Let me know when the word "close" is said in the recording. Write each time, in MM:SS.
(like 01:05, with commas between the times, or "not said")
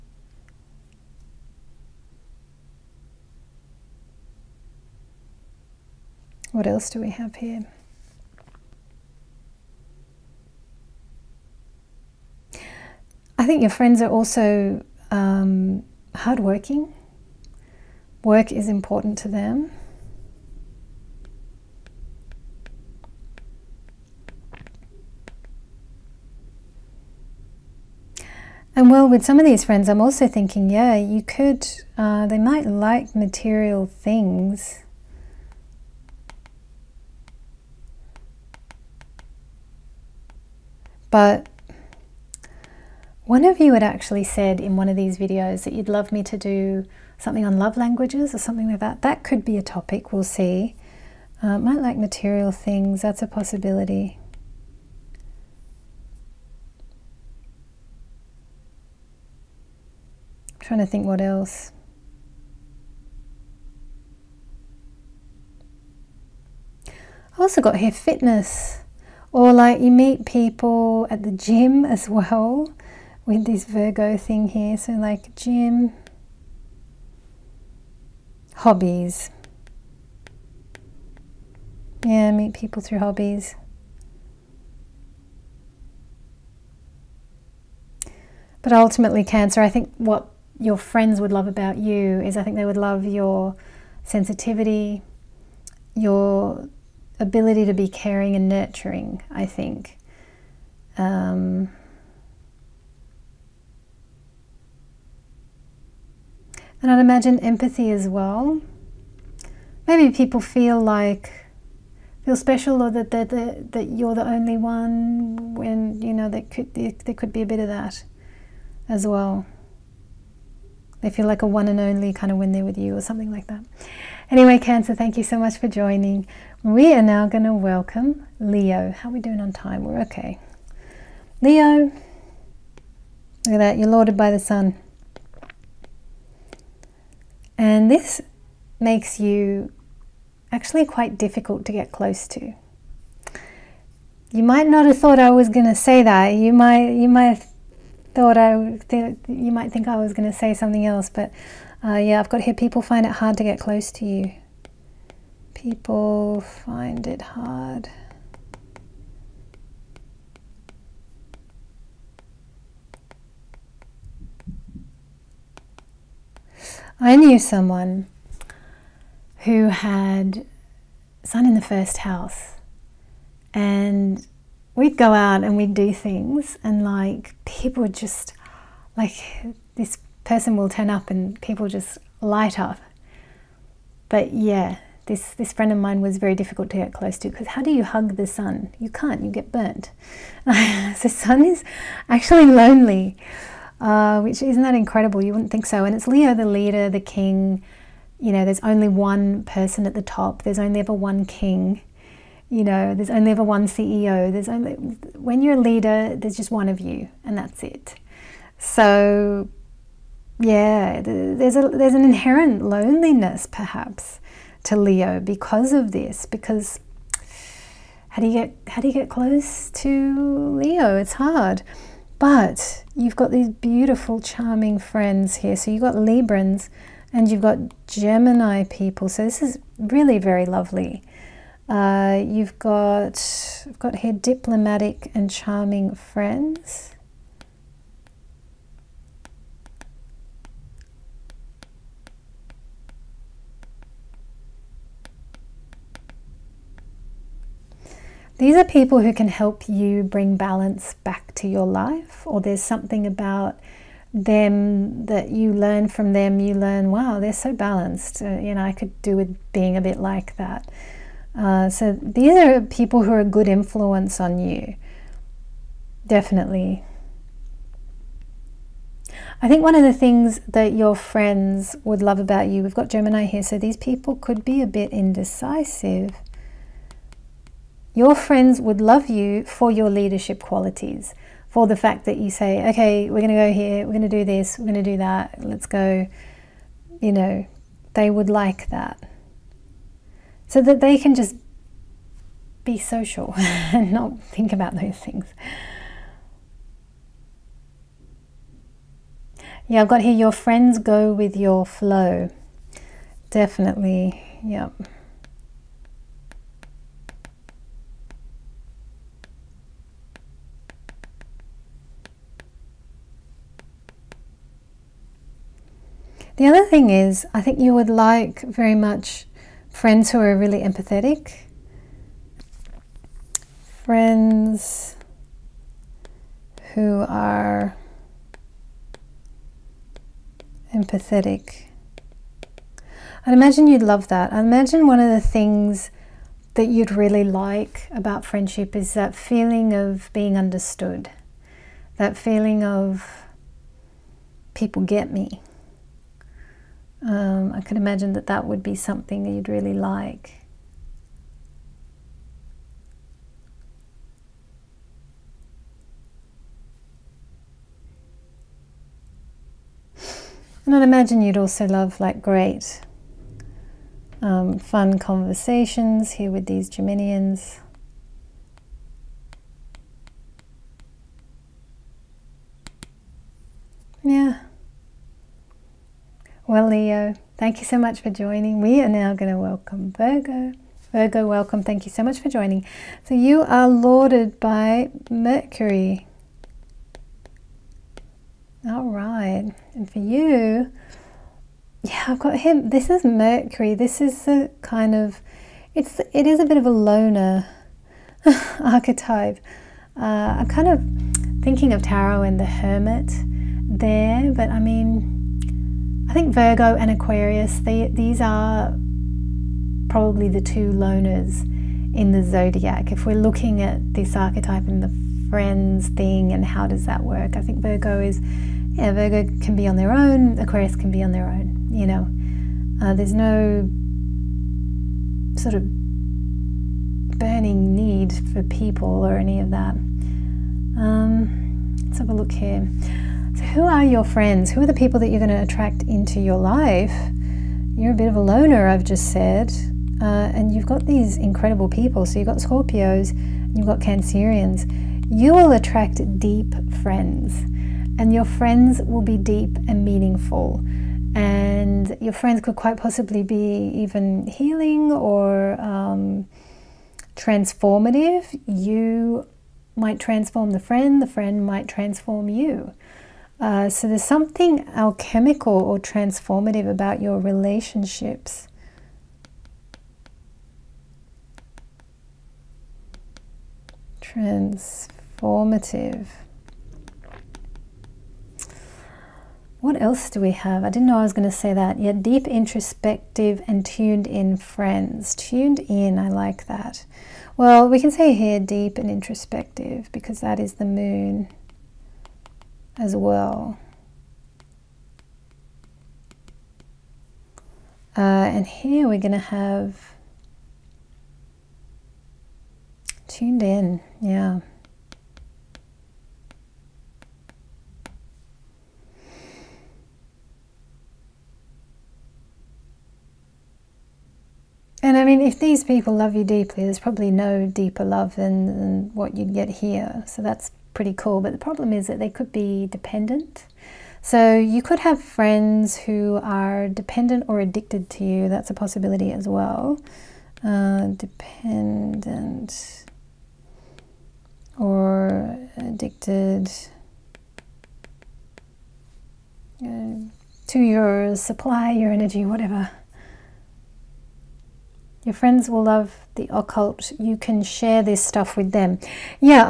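02:21, 02:33, 03:06, 03:39.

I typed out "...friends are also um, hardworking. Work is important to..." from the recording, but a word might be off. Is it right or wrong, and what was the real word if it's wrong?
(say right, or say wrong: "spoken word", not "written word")
right.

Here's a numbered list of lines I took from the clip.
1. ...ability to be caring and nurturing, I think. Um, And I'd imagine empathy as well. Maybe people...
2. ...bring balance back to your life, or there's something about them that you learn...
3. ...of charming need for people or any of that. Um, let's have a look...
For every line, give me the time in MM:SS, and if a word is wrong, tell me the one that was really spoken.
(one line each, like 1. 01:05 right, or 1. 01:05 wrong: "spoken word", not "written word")
1. 01:37 right
2. 04:10 right
3. 07:05 wrong: "burning", not "charming".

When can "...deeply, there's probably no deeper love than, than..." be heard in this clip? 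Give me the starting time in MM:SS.
08:36.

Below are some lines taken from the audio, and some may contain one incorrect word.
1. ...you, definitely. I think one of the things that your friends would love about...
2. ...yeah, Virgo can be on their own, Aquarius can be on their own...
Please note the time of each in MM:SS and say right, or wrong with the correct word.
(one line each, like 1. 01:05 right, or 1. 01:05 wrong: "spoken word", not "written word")
1. 04:24 right
2. 06:58 right.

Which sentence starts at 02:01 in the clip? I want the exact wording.
They feel like a one and only kind of when they're with you or something like that.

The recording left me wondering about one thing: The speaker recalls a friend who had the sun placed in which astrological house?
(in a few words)
First house.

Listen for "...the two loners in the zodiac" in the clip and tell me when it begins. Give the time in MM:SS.
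06:50.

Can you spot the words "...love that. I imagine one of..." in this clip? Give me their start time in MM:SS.
05:33.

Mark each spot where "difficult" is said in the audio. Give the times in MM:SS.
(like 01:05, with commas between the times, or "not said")
02:21, 03:06.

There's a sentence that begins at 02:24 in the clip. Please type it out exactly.
You might not have thought I was going to say that.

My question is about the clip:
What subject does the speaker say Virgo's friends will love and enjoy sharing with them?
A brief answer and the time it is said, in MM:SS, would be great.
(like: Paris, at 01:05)
The occult, at 09:06.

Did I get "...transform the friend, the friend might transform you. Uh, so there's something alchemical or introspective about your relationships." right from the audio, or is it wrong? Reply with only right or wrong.
wrong.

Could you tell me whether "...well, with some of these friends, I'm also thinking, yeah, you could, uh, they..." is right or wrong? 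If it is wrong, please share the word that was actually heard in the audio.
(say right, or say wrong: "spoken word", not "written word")
right.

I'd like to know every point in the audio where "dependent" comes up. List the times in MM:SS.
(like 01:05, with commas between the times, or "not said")
08:42, 08:46, 08:51.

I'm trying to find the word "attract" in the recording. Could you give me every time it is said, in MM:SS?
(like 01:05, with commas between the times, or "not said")
07:15, 07:25.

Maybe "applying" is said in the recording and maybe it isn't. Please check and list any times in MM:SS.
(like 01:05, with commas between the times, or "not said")
not said.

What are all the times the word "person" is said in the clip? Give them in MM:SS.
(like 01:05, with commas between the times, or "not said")
03:00, 03:19.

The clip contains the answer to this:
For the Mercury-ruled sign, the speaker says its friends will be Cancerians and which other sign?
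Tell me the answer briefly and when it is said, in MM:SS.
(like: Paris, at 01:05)
Scorpios, at 07:22.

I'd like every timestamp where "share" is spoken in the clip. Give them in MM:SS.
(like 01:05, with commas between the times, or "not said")
09:07.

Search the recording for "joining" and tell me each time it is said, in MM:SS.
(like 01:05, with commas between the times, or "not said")
02:05, 06:18, 06:22.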